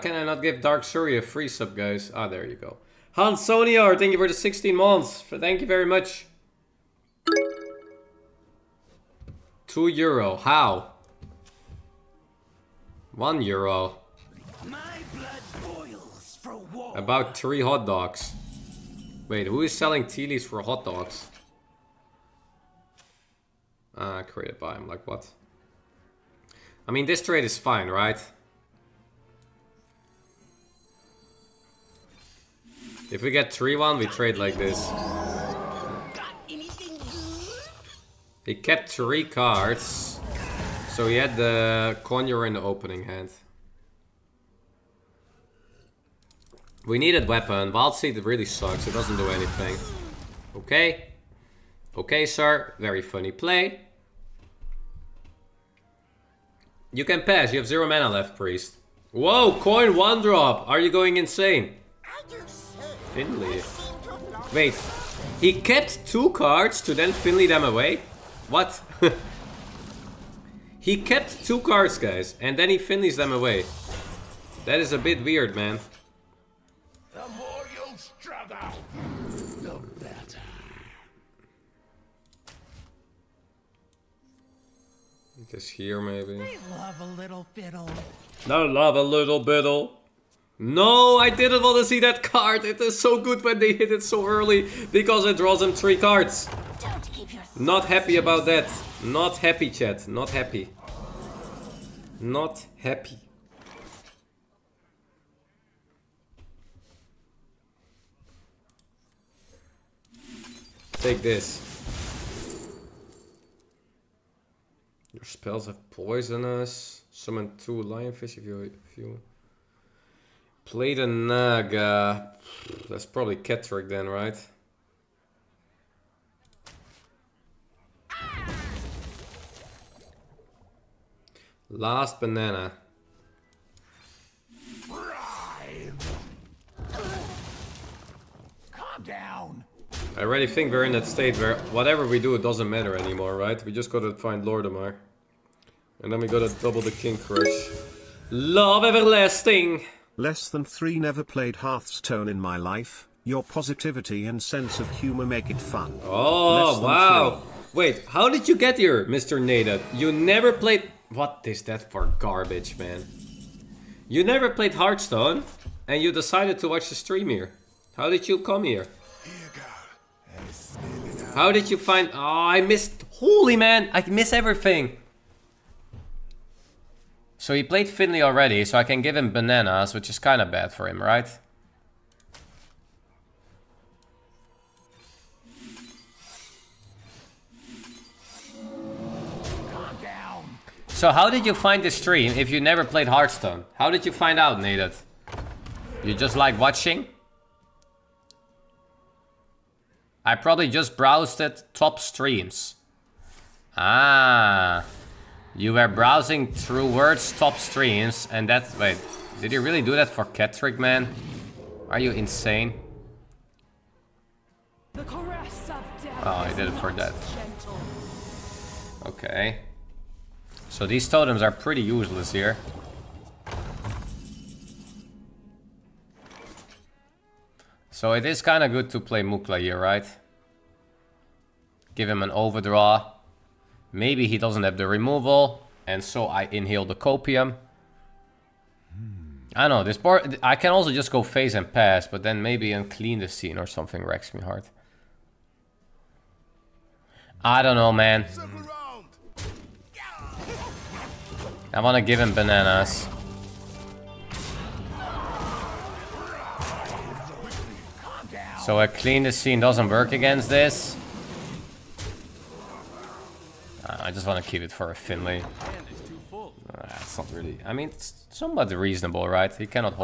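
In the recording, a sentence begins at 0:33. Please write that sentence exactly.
If we get 3-1, we trade like this.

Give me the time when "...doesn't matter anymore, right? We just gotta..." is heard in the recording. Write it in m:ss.
2:22.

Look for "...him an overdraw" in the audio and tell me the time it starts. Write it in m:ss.
3:52.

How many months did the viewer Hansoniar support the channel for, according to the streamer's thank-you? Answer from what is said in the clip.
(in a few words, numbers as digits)
16.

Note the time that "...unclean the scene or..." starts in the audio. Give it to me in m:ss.
4:02.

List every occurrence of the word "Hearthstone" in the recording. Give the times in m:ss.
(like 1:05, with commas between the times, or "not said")
2:31, 2:44, 3:13.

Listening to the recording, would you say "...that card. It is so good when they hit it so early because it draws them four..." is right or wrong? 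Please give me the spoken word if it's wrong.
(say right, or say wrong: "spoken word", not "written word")
wrong: "three", not "four".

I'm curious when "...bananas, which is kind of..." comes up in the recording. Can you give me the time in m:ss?
2:59.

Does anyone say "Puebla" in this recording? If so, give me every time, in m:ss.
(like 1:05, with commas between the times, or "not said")
not said.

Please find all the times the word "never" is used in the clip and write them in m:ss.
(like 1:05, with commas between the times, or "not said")
2:30, 2:40, 2:44, 3:12.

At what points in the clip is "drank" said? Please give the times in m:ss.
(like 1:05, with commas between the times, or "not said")
not said.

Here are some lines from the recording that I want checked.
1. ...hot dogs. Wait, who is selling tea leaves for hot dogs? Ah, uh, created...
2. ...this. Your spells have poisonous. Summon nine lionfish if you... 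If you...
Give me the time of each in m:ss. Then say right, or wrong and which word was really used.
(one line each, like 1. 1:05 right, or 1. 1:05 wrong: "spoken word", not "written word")
1. 0:17 right
2. 1:51 wrong: "two", not "nine".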